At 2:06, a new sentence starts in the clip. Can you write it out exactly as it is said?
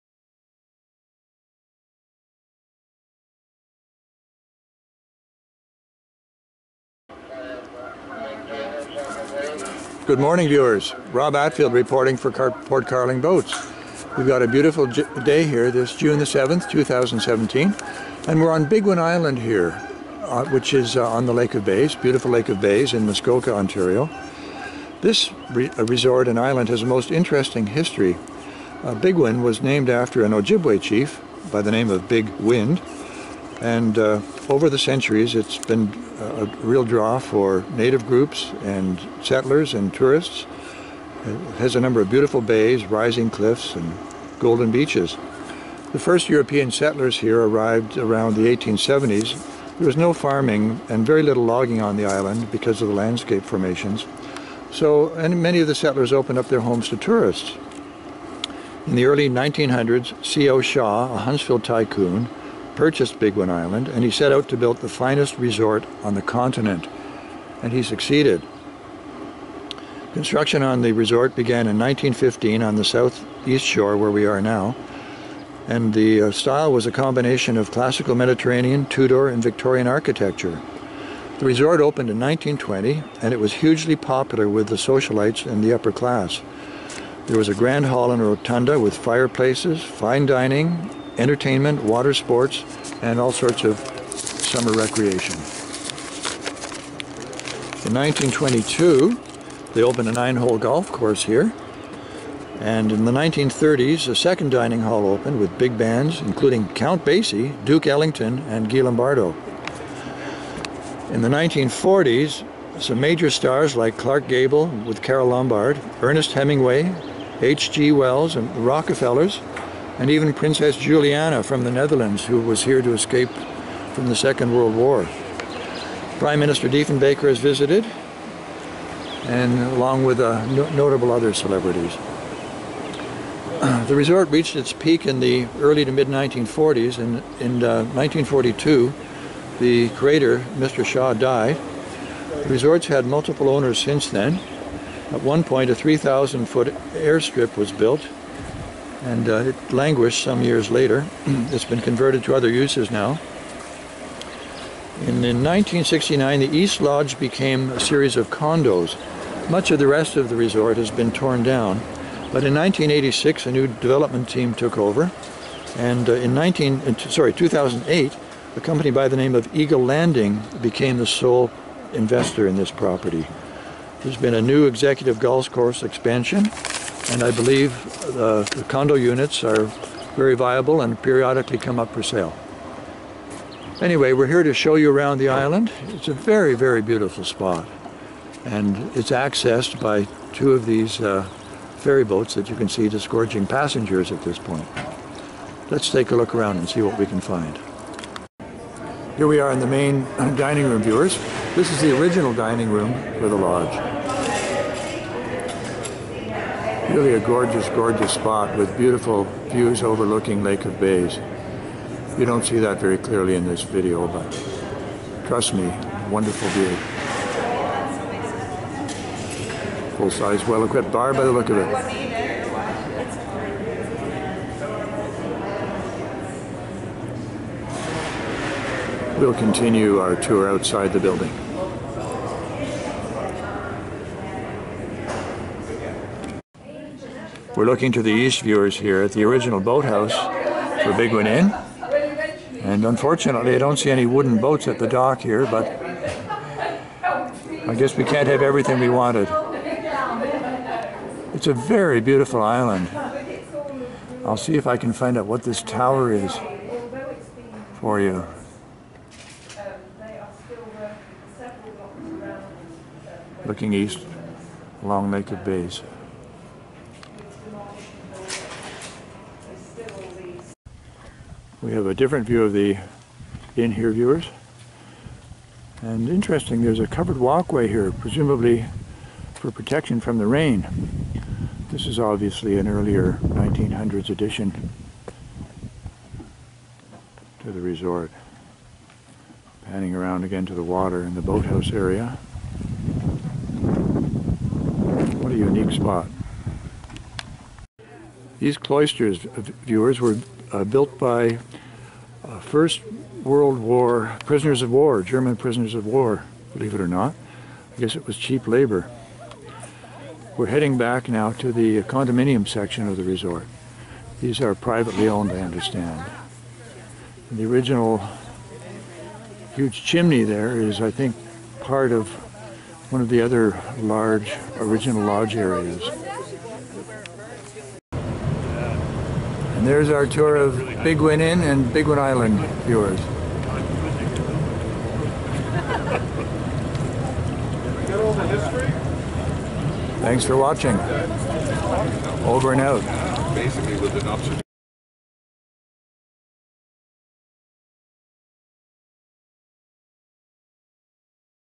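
Prime Minister Diefenbaker has visited, and along with uh, no notable other celebrities.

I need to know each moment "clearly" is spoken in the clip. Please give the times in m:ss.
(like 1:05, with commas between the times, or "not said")
3:32.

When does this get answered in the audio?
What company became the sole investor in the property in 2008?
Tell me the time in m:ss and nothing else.
2:49.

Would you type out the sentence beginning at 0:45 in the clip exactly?
The first European settlers here arrived around the 1870s.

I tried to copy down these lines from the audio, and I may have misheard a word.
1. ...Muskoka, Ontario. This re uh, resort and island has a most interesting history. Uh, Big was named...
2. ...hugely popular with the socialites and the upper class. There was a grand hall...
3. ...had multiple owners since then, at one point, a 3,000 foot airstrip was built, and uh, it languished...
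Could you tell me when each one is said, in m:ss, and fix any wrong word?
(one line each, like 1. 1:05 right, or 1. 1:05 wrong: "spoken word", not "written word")
1. 0:23 right
2. 1:23 right
3. 2:22 right.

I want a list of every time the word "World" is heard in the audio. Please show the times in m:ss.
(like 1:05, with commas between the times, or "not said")
2:04, 5:03.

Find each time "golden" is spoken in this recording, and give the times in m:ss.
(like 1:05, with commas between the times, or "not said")
0:44.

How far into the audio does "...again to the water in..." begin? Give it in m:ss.
4:50.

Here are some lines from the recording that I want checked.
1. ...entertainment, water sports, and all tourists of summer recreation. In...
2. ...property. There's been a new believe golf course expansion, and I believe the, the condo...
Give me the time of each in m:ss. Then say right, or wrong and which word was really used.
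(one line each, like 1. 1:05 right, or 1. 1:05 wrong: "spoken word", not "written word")
1. 1:31 wrong: "sorts", not "tourists"
2. 2:52 wrong: "executive", not "believe".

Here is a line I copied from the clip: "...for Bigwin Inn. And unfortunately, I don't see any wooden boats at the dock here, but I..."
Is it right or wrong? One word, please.
right.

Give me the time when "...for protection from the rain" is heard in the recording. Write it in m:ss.
4:39.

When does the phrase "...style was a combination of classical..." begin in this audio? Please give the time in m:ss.
1:16.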